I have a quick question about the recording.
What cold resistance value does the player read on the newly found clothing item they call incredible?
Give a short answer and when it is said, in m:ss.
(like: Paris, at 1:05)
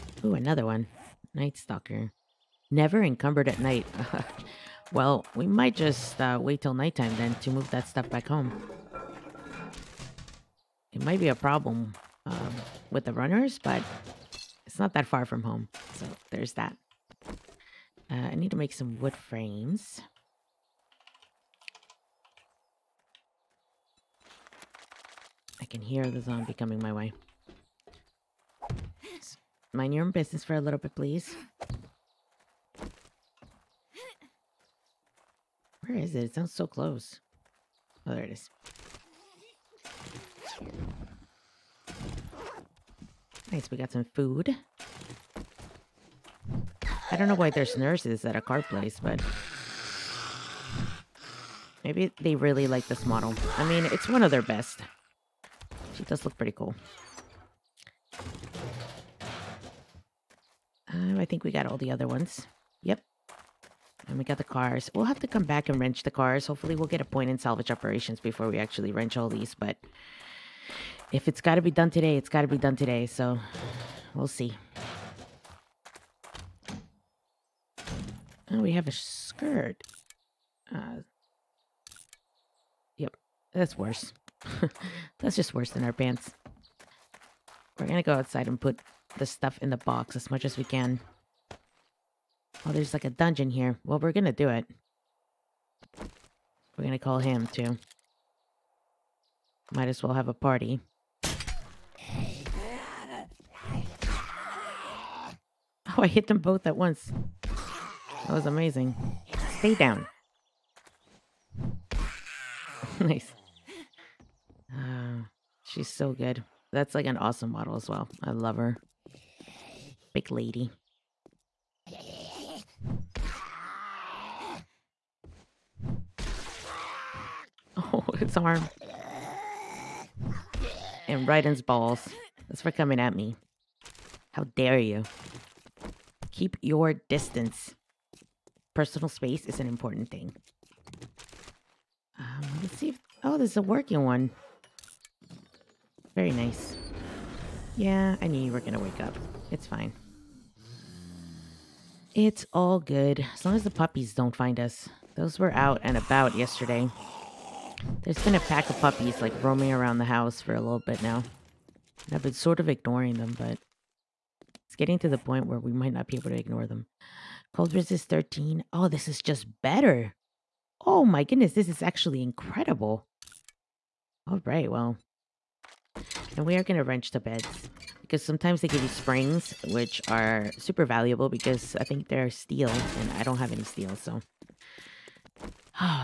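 13, at 2:47.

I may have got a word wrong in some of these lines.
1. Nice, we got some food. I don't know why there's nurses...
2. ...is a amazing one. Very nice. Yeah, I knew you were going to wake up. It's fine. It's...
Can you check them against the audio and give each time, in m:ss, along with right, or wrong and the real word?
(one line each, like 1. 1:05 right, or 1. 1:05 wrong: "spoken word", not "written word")
1. 0:43 right
2. 2:23 wrong: "working", not "amazing".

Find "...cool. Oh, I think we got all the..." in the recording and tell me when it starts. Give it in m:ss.
0:56.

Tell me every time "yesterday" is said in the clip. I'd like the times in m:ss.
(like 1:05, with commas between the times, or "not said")
2:36.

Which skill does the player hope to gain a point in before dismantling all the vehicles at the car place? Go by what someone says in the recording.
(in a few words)
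salvage operations.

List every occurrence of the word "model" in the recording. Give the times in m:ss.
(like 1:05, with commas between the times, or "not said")
0:53, 1:57.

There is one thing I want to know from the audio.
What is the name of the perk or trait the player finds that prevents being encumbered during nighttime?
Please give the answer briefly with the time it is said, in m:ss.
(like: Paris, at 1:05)
Night Stalker, at 0:01.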